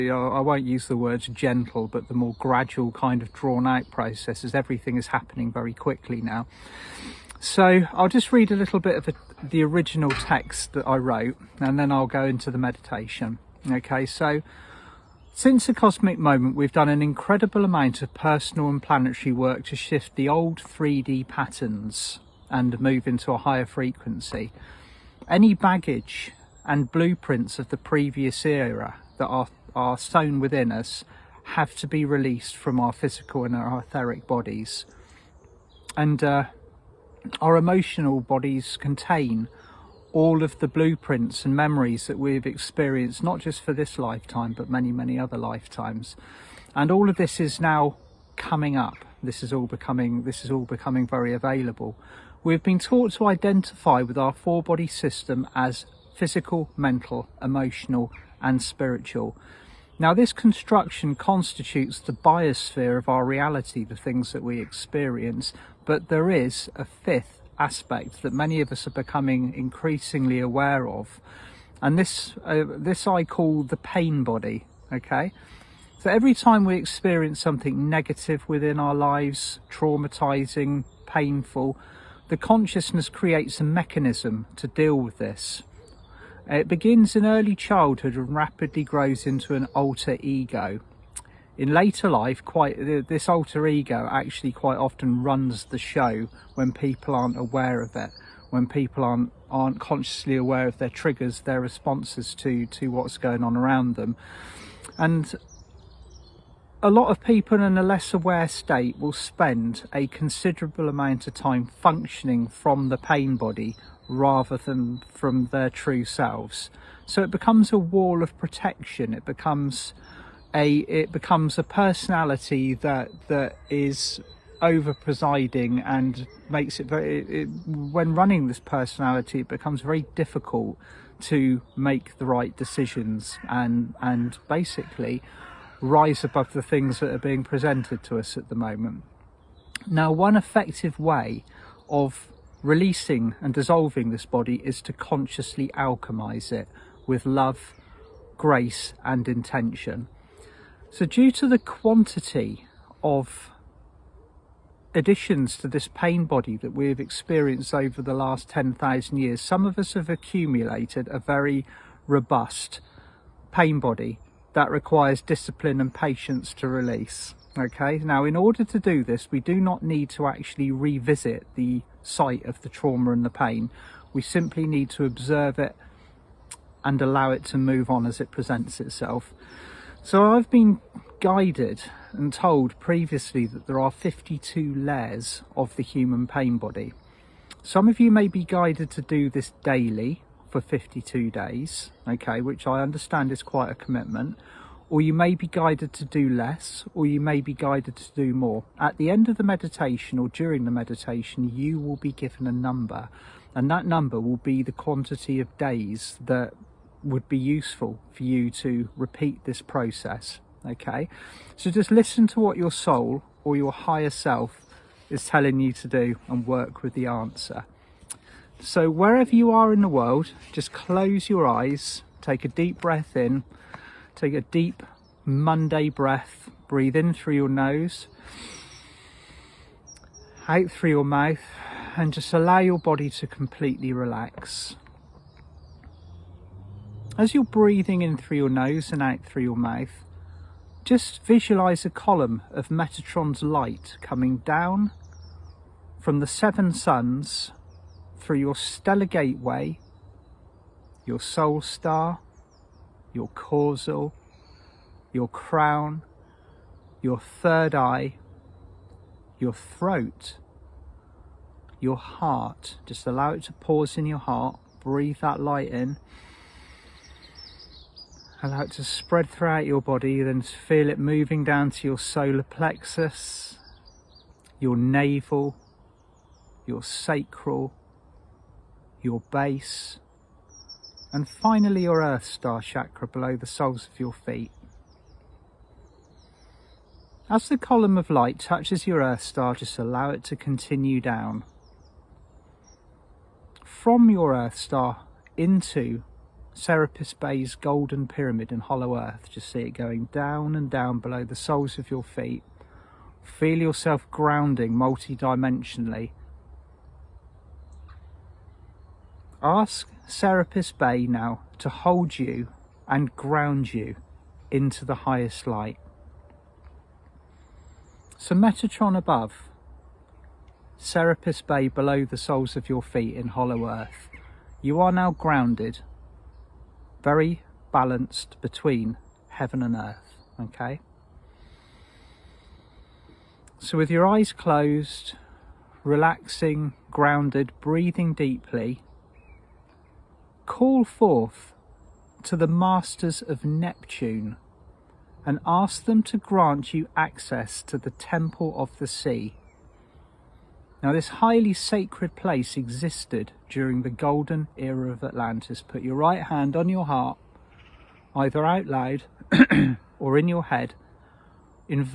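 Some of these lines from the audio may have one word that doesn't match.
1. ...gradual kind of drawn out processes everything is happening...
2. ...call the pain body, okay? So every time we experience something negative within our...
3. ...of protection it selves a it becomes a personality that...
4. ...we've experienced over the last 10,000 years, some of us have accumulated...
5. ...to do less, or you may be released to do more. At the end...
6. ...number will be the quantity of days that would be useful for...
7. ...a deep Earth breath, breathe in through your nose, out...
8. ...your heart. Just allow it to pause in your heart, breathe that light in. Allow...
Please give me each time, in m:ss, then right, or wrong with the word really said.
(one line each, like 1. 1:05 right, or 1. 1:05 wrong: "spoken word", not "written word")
1. 0:02 right
2. 1:13 right
3. 1:58 wrong: "becomes", not "selves"
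4. 2:36 right
5. 3:15 wrong: "guided", not "released"
6. 3:23 right
7. 3:44 wrong: "Monday", not "Earth"
8. 4:21 right.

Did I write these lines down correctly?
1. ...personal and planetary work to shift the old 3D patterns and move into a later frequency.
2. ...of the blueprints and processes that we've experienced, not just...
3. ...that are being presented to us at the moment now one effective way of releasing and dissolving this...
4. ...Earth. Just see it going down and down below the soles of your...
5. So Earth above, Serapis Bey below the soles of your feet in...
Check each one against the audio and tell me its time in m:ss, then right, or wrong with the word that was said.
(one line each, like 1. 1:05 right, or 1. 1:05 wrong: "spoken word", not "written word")
1. 0:18 wrong: "higher", not "later"
2. 0:40 wrong: "memories", not "processes"
3. 2:17 right
4. 4:58 right
5. 5:18 wrong: "Metatron", not "Earth".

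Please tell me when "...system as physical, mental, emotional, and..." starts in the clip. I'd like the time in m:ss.
0:54.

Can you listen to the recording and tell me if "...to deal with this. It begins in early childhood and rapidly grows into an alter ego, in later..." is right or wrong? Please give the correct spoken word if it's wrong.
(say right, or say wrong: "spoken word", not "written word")
right.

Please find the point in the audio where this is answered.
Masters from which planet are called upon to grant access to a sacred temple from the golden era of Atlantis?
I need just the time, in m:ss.
5:43.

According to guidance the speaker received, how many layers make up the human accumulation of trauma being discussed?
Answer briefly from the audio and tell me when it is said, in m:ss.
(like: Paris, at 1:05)
52, at 3:03.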